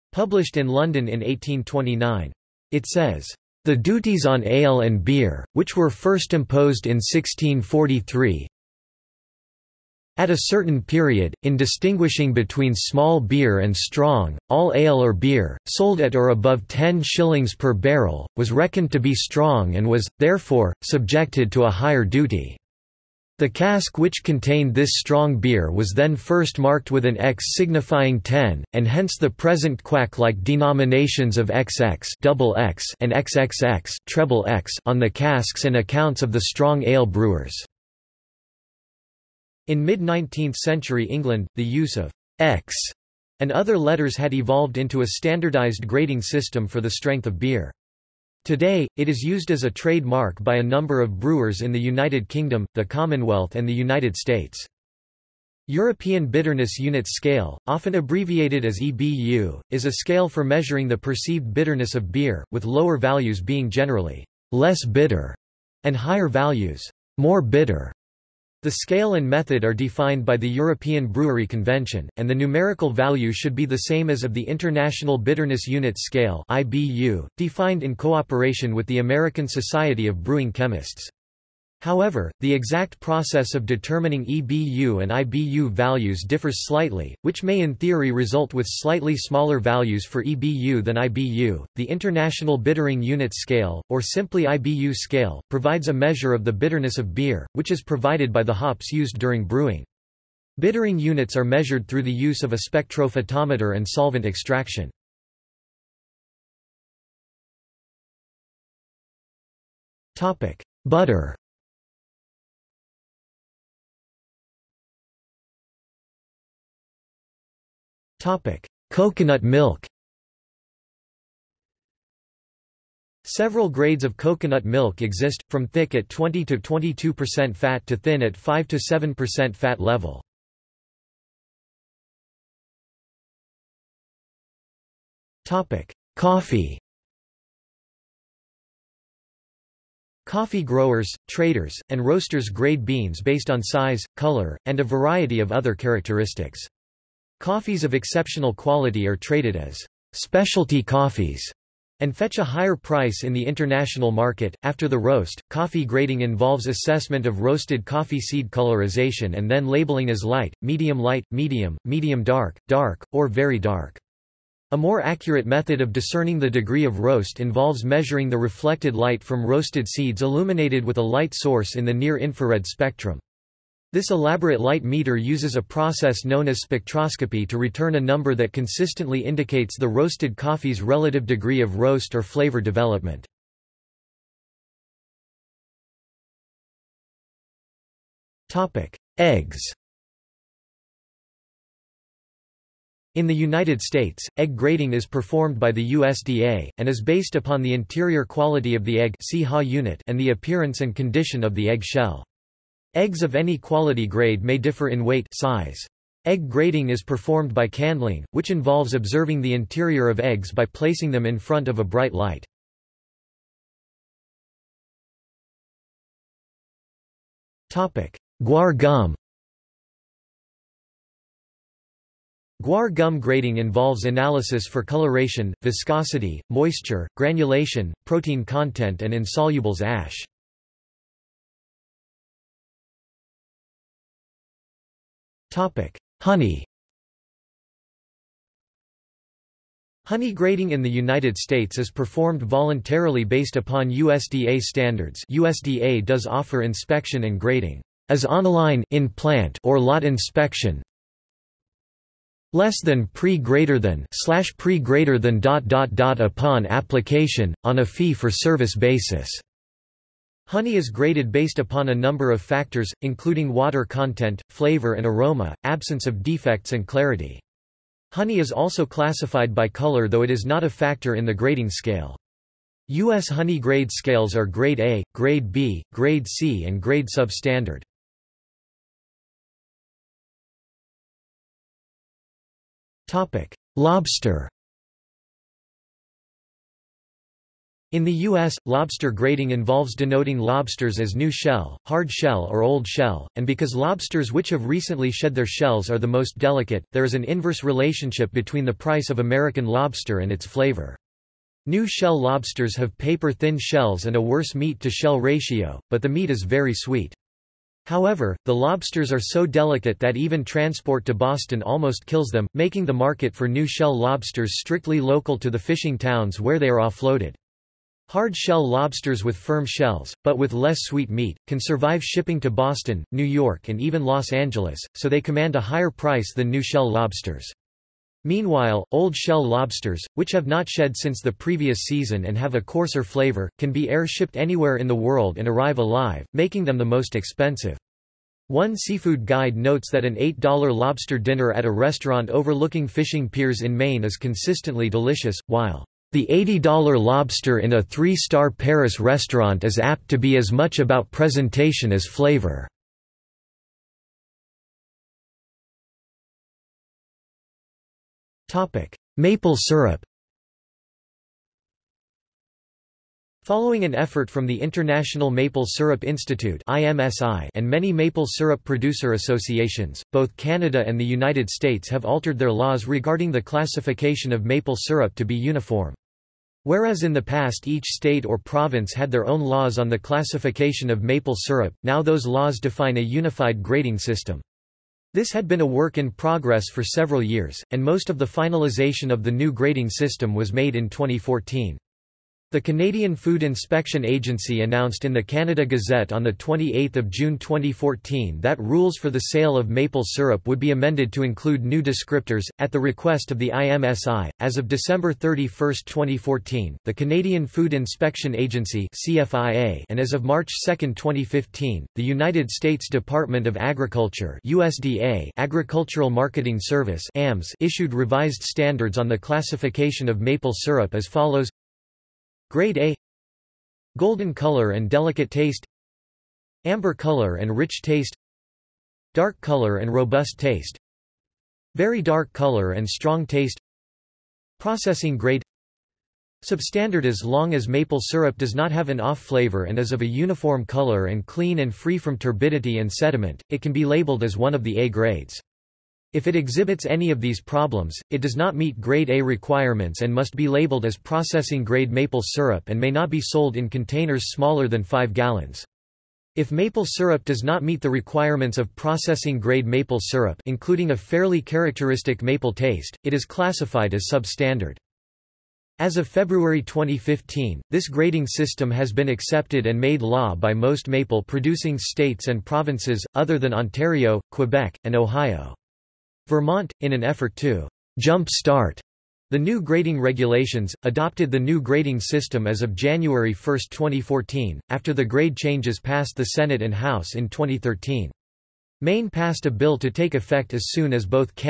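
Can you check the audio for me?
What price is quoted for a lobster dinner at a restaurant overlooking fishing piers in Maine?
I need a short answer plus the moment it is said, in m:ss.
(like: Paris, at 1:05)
$8, at 5:40.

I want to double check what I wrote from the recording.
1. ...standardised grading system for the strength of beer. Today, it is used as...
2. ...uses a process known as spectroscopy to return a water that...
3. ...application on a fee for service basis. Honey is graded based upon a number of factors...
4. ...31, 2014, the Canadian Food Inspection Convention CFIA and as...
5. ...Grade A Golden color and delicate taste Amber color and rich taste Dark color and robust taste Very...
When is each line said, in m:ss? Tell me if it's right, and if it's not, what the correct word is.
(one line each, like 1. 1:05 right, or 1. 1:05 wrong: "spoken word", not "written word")
1. 0:45 right
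2. 2:55 wrong: "number", not "water"
3. 4:16 right
4. 6:45 wrong: "Agency", not "Convention"
5. 7:02 right.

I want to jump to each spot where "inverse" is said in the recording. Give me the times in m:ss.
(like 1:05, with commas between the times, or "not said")
4:57.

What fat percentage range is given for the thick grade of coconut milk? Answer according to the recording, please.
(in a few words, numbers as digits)
20 to 22%.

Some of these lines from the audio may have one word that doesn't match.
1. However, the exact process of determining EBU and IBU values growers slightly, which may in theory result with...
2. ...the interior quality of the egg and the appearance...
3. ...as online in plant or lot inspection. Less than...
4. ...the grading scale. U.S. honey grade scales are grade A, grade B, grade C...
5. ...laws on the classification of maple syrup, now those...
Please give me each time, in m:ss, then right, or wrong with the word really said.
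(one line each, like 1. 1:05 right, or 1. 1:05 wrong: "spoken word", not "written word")
1. 1:21 wrong: "differs", not "growers"
2. 3:17 right
3. 4:08 right
4. 4:31 right
5. 6:19 right.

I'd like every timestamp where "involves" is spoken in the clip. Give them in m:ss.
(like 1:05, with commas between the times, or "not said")
2:36, 2:47, 3:28, 3:43, 4:49.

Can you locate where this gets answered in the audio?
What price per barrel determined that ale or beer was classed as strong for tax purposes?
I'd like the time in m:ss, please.
0:16.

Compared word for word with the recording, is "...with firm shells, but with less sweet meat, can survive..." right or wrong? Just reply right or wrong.
right.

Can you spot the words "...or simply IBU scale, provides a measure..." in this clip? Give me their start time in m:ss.
1:33.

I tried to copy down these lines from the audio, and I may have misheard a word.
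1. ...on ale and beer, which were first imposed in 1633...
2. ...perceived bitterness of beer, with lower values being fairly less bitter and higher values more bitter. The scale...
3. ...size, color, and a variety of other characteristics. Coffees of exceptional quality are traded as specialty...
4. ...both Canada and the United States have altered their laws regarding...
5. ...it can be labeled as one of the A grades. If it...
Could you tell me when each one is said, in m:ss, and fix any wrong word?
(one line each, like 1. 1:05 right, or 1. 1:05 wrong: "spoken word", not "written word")
1. 0:04 wrong: "1643", not "1633"
2. 1:00 wrong: "generally", not "fairly"
3. 2:23 right
4. 6:10 right
5. 7:23 right.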